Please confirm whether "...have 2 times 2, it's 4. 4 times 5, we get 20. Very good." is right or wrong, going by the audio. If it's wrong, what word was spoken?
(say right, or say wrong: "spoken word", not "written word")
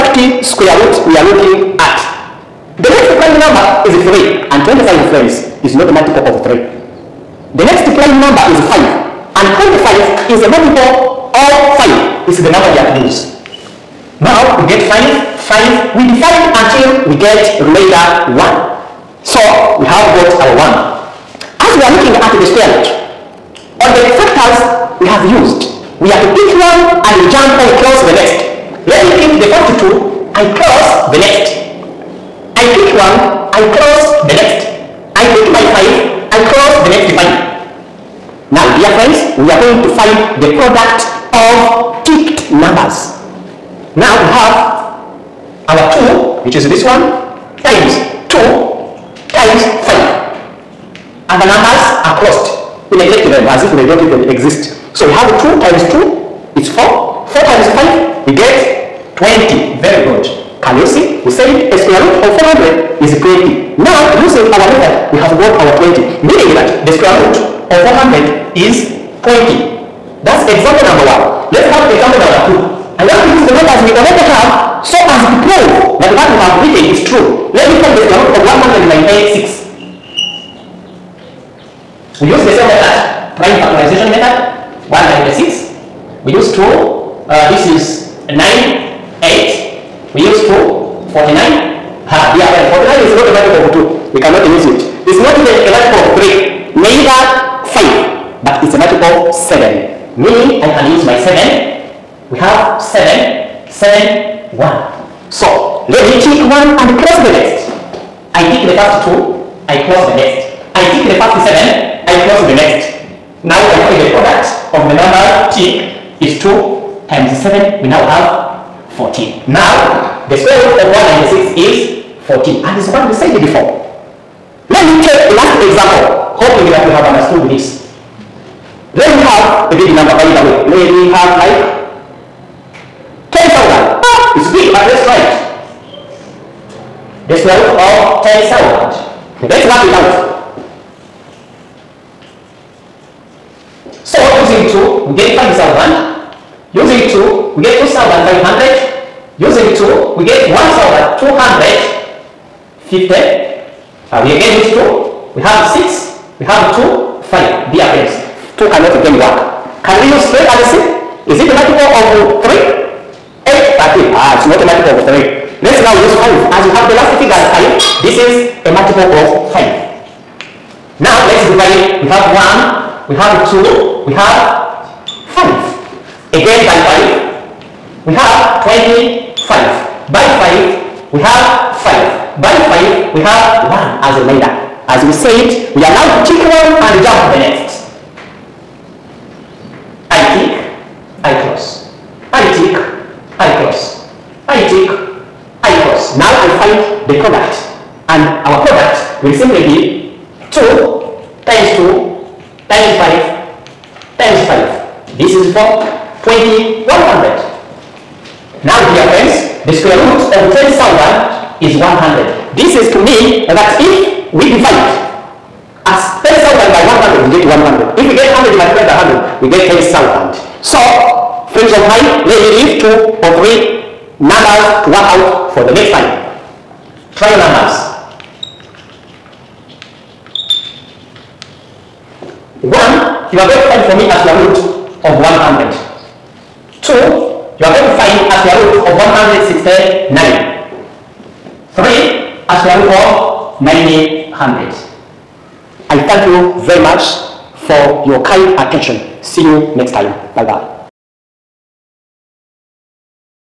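right.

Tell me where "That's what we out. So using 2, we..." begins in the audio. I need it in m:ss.
2:19.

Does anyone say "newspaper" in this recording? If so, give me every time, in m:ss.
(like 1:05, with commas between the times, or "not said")
not said.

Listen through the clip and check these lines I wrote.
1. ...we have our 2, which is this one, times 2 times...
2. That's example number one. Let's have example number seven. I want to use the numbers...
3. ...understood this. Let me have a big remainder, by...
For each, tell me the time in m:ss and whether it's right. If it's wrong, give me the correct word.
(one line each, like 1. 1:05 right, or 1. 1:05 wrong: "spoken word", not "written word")
1. 0:44 right
2. 1:10 wrong: "two", not "seven"
3. 2:07 wrong: "number", not "remainder".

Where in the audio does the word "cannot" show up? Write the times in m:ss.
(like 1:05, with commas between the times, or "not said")
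1:34, 2:38.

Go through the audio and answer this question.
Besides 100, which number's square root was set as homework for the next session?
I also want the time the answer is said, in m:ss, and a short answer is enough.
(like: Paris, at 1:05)
169, at 3:58.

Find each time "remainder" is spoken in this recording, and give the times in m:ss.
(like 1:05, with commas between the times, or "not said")
0:17, 3:04.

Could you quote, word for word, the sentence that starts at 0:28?
Let me pick the 42 and close the next.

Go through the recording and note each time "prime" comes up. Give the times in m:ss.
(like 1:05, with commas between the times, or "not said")
0:03, 0:07, 1:23.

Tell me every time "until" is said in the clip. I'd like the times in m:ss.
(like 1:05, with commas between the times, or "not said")
0:16.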